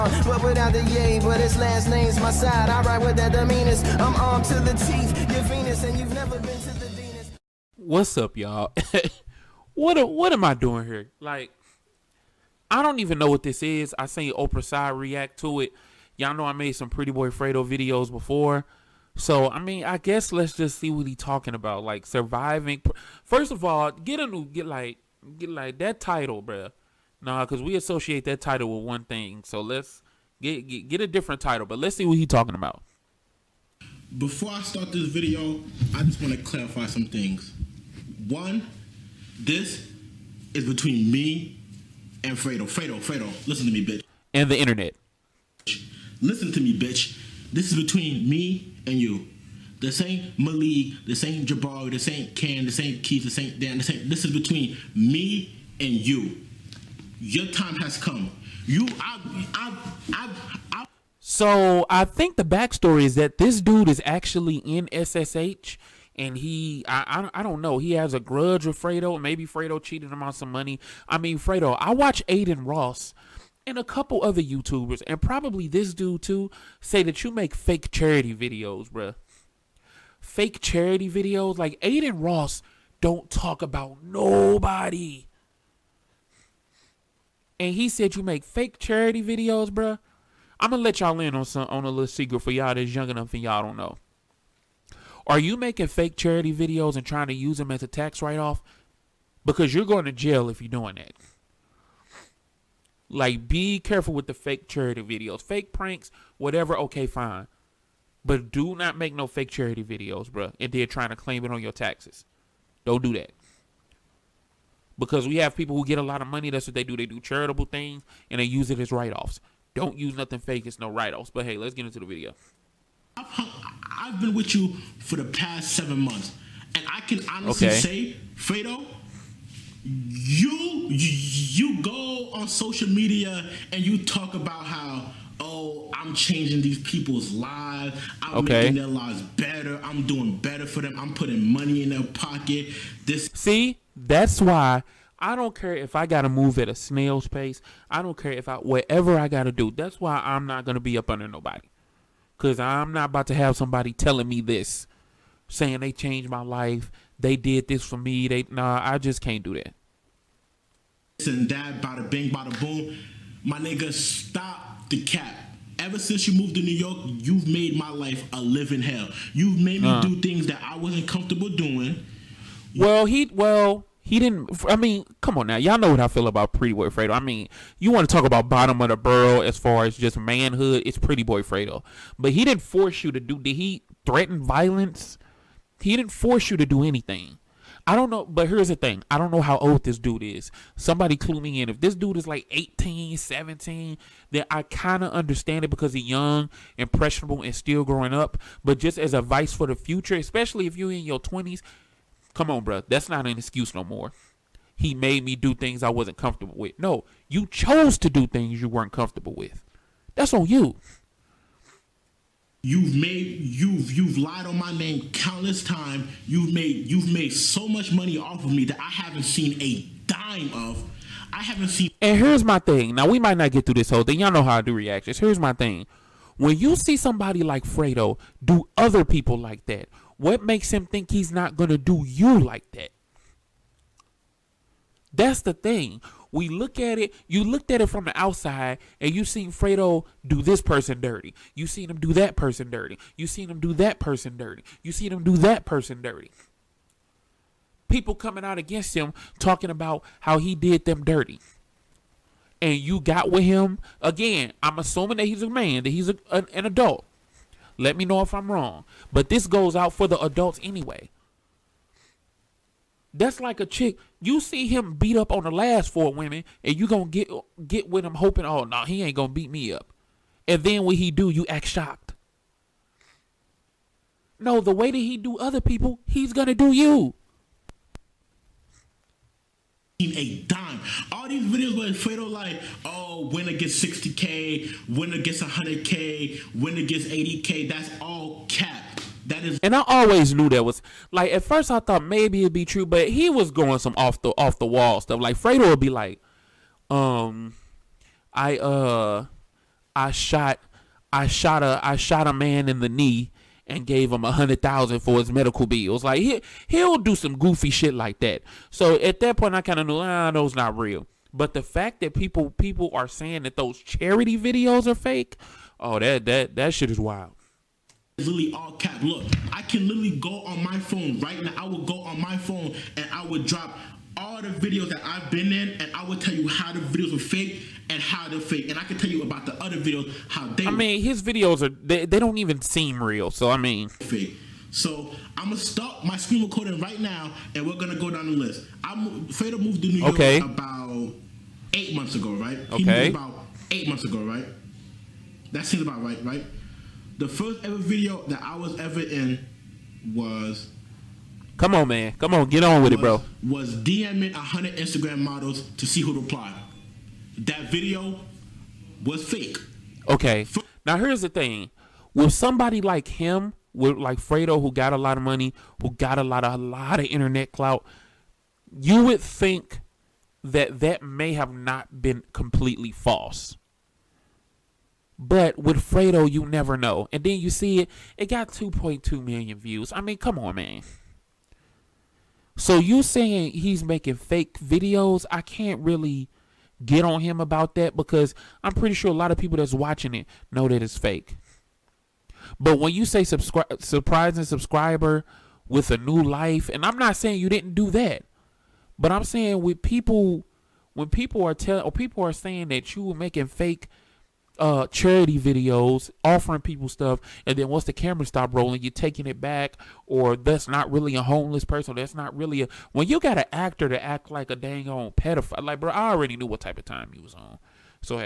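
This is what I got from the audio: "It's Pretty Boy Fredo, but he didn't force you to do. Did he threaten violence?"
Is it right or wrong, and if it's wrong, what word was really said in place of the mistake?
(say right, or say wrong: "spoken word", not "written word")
right.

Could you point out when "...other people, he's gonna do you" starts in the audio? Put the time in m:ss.
4:35.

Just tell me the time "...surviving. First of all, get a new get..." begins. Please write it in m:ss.
0:22.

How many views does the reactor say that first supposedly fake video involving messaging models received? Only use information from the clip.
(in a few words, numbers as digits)
2.2 million.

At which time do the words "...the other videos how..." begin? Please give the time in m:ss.
5:29.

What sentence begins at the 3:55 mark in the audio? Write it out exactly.
That's the thing we look at it, you looked at it from the outside and you seen Fredo do this person dirty.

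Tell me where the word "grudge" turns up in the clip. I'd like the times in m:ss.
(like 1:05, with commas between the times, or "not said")
1:08.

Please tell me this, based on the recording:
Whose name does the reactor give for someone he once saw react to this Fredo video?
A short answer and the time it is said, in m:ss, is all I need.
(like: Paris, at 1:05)
Oprah side, at 0:14.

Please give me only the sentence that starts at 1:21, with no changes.
Like Adin Ross don't talk about nobody.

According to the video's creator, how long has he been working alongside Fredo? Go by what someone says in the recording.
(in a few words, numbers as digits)
seven months.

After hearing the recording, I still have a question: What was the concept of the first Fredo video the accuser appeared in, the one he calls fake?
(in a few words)
DMing hundred Instagram models.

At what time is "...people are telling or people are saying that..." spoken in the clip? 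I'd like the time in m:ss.
6:41.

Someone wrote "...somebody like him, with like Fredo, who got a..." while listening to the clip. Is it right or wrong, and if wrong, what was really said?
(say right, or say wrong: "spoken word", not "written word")
right.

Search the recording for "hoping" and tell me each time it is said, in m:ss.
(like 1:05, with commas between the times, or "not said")
4:28.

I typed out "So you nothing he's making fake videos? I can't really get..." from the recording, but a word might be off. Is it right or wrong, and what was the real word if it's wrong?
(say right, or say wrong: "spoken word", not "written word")
wrong: "saying", not "nothing".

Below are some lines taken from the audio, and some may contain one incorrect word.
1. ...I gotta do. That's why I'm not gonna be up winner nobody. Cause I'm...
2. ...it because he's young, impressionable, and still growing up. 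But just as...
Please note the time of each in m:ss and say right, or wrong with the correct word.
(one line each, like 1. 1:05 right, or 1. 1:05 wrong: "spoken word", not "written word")
1. 2:29 wrong: "under", not "winner"
2. 3:15 right.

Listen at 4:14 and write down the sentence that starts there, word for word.
I'm assuming that he's a man, that he's a, an, an adult.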